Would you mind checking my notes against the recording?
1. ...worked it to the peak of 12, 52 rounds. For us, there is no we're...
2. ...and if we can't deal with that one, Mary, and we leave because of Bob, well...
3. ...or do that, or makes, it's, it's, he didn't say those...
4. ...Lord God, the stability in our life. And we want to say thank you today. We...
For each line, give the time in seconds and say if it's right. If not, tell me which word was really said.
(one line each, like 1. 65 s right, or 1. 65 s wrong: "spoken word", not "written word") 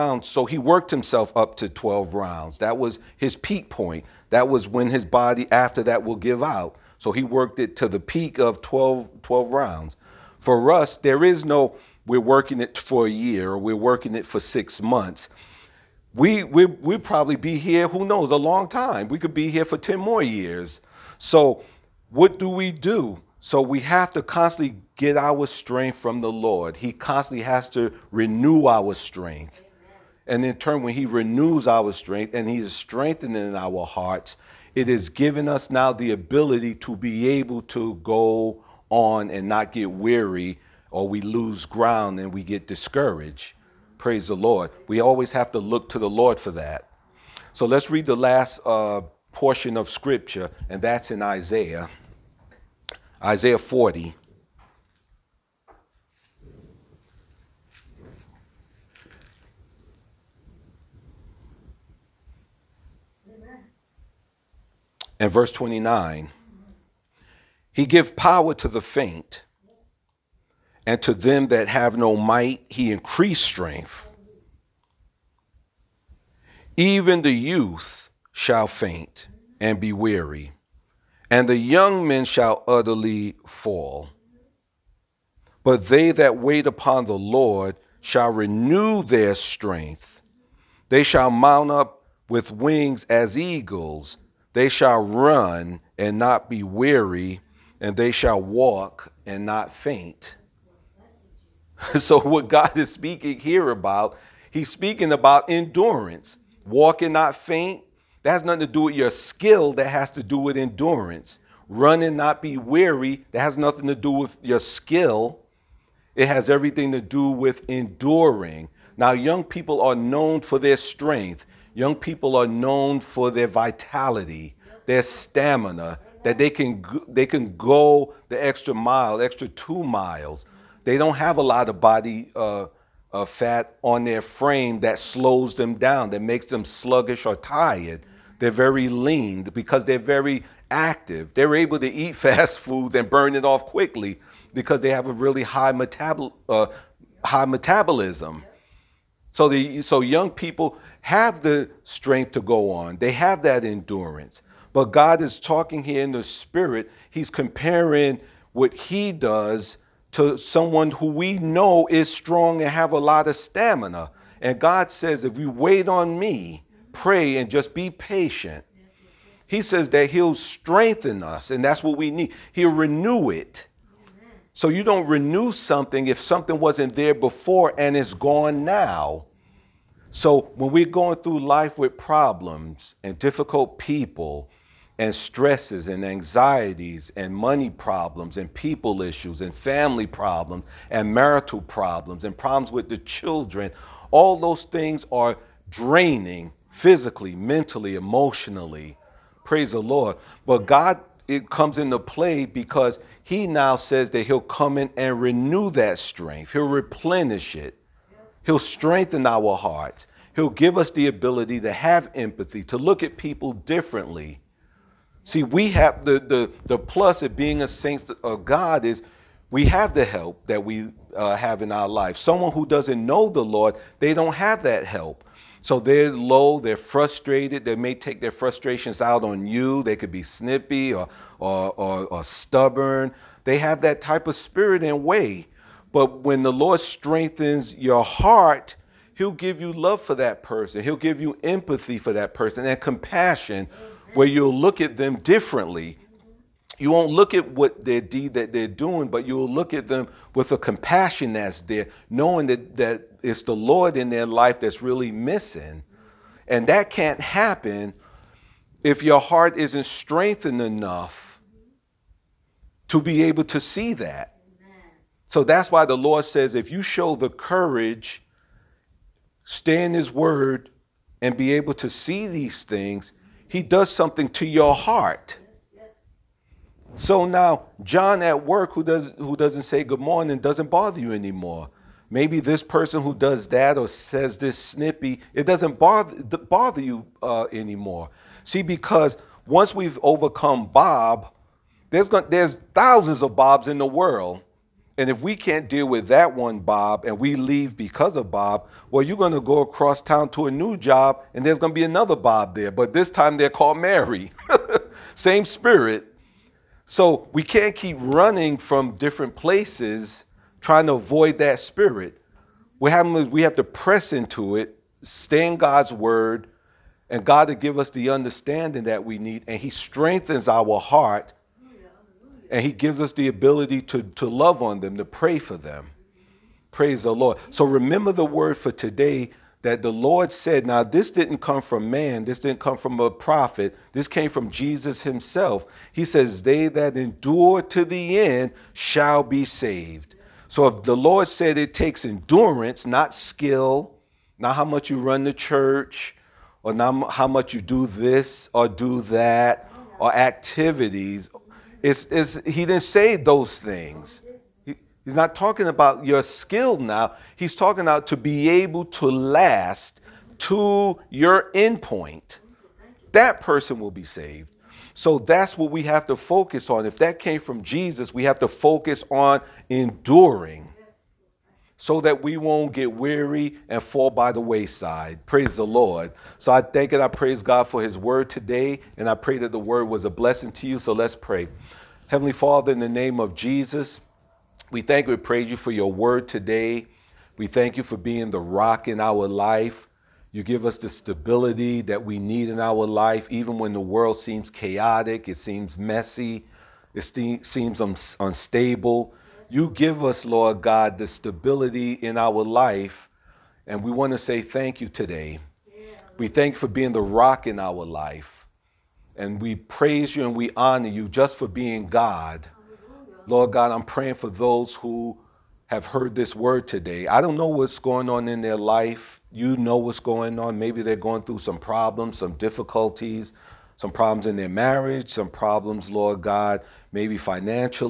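1. 7 s wrong: "12", not "52"
2. 294 s wrong: "Bob", not "Mary"
3. 348 s wrong: "activities", not "makes"
4. 400 s right.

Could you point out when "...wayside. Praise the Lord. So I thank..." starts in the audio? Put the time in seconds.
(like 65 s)
374 s.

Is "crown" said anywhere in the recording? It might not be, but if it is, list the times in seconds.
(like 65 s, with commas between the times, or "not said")
not said.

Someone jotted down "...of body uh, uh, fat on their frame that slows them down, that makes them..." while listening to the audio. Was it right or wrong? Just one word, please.
right.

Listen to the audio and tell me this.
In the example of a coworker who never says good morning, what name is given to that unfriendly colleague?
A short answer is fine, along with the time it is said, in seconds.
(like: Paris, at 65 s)
John, at 277 s.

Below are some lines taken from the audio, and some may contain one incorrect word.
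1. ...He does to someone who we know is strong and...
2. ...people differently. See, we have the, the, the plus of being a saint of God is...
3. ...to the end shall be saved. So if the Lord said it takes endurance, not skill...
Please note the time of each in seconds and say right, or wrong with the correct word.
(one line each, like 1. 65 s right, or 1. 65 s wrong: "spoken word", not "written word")
1. 158 s right
2. 213 s right
3. 337 s right.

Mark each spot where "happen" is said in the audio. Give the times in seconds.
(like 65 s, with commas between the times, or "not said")
257 s, 312 s.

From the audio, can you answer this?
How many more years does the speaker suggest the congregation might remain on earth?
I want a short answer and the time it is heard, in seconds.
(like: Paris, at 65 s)
10, at 19 s.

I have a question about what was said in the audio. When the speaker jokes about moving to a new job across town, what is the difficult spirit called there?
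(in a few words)
Mary.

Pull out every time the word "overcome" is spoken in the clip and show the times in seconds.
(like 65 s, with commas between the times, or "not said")
290 s.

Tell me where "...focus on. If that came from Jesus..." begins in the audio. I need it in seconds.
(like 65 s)
366 s.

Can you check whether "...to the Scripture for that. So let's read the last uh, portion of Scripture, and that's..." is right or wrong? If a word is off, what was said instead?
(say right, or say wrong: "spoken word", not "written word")
wrong: "Lord", not "Scripture".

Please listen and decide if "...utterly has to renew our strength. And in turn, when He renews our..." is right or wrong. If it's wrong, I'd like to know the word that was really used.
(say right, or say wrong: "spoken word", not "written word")
wrong: "constantly", not "utterly".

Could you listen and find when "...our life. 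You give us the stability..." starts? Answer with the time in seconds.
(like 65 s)
388 s.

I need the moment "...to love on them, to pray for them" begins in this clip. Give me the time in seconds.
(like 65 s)
324 s.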